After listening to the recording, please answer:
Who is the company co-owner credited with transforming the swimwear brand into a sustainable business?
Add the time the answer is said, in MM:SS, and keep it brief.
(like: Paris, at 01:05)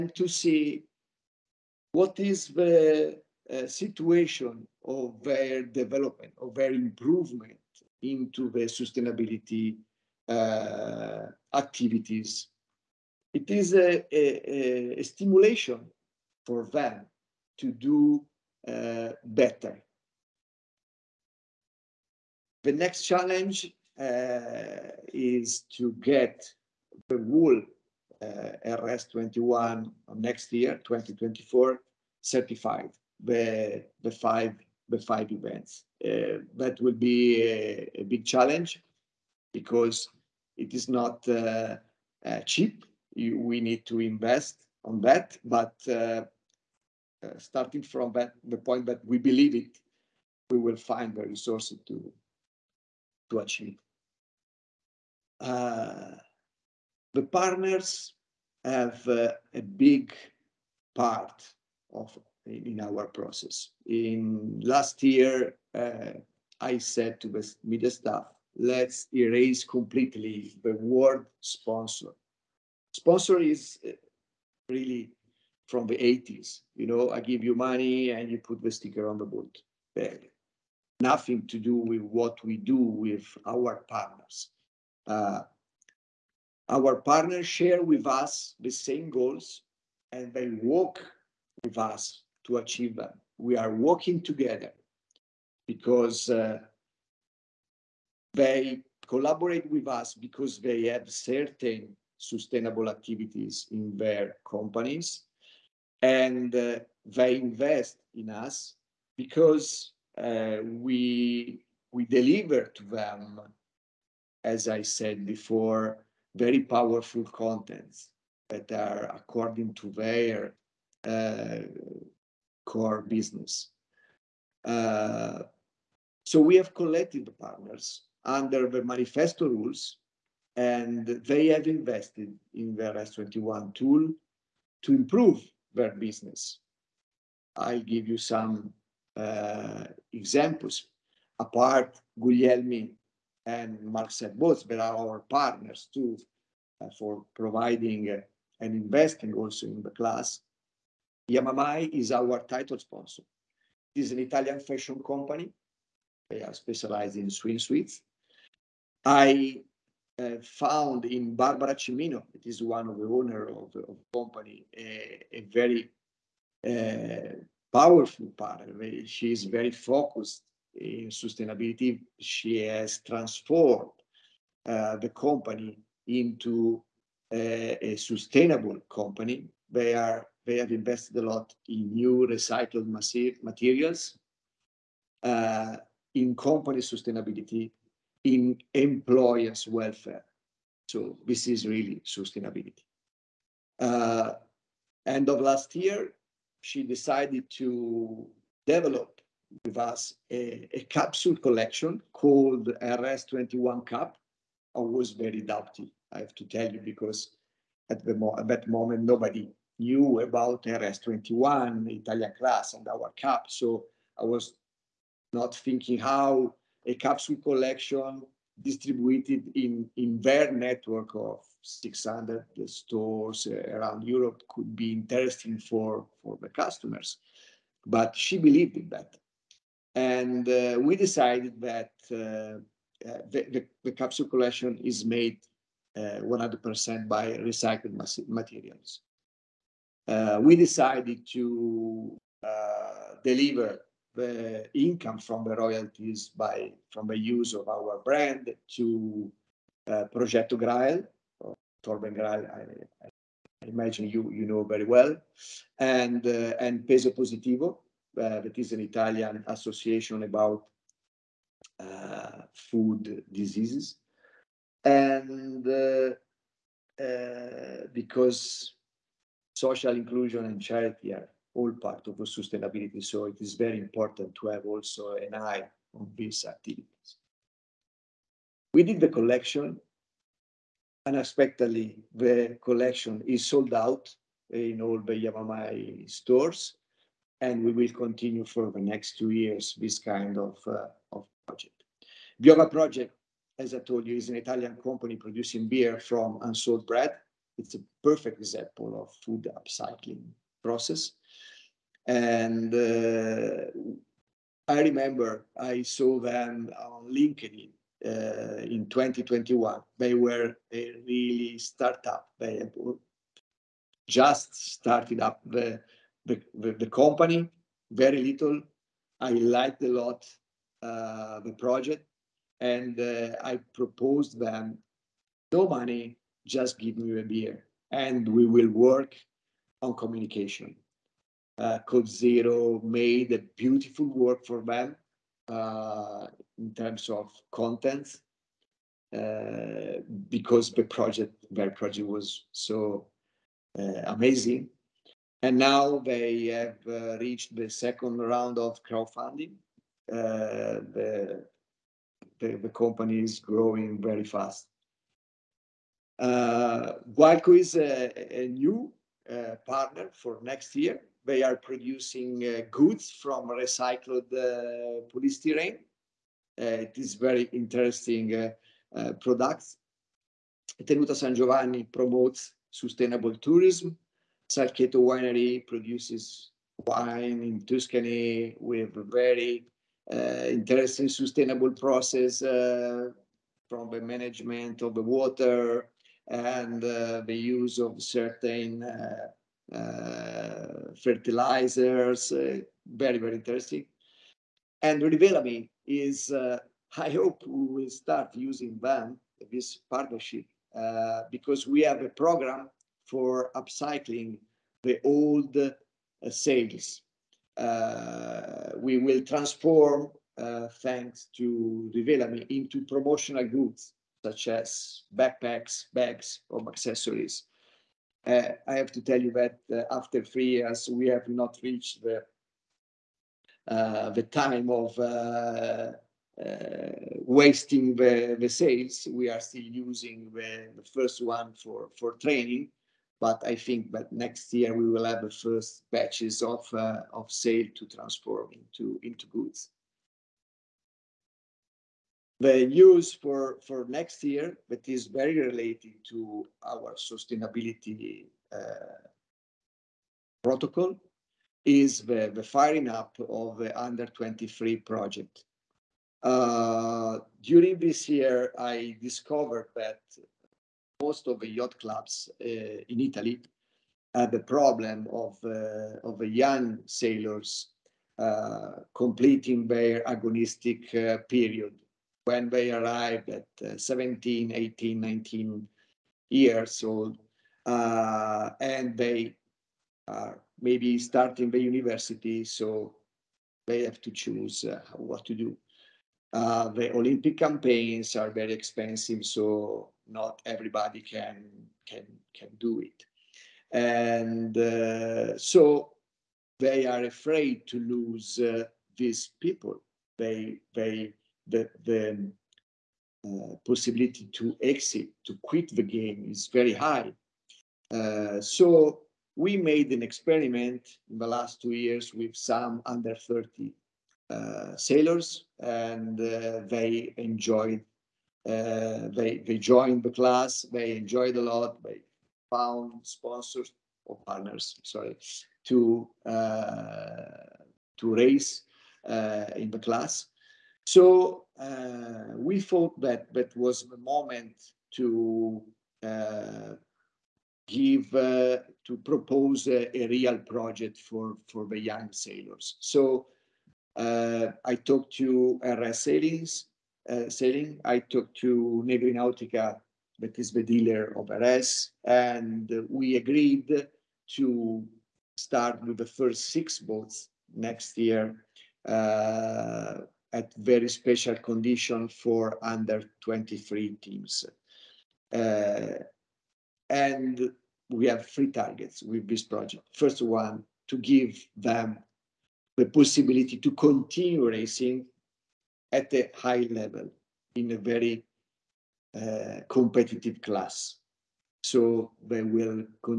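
Barbara Cimmino, at 02:41.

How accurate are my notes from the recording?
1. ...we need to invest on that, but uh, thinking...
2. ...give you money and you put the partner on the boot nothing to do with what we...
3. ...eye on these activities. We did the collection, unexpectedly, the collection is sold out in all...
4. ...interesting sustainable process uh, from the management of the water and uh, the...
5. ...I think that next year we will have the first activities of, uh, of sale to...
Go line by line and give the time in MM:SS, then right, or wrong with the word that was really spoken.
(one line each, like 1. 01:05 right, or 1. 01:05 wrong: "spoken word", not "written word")
1. 00:43 wrong: "starting", not "thinking"
2. 01:17 wrong: "sticker", not "partner"
3. 04:35 right
4. 06:20 right
5. 07:13 wrong: "batches", not "activities".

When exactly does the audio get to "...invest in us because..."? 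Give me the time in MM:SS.
01:47.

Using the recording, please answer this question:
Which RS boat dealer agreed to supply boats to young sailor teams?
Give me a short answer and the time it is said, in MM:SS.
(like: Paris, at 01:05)
Negri Nautica, at 09:08.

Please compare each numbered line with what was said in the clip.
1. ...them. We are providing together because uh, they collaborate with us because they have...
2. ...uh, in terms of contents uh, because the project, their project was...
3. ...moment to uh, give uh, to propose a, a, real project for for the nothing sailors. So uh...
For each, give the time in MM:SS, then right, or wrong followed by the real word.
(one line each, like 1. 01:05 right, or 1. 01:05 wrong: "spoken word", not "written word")
1. 01:32 wrong: "working", not "providing"
2. 05:35 right
3. 08:53 wrong: "young", not "nothing".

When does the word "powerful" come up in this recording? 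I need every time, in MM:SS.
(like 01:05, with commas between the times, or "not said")
01:56, 02:47.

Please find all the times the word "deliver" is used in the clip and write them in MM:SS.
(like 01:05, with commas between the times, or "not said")
01:52, 04:03.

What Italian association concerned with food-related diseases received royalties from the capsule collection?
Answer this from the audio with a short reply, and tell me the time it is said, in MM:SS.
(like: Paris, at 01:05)
Peso Positivo, at 04:16.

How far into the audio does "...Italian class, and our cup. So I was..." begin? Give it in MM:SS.
03:31.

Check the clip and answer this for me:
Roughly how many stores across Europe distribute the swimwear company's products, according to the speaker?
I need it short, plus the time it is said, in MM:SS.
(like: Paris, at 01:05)
600, at 03:41.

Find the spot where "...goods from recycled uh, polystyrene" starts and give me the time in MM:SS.
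06:02.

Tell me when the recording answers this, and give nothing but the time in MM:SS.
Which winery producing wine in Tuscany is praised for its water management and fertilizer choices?
06:14.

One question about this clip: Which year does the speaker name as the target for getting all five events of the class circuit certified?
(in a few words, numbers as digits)
2024.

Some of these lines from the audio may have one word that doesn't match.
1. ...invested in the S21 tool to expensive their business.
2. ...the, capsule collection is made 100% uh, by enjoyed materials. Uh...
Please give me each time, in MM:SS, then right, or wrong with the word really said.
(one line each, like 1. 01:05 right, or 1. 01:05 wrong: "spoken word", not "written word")
1. 02:11 wrong: "improve", not "expensive"
2. 03:53 wrong: "recycled", not "enjoyed".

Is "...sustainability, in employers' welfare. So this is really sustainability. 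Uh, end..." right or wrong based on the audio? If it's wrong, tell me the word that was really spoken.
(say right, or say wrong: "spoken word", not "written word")
right.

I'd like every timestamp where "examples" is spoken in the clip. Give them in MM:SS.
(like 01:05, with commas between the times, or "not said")
02:20, 04:58.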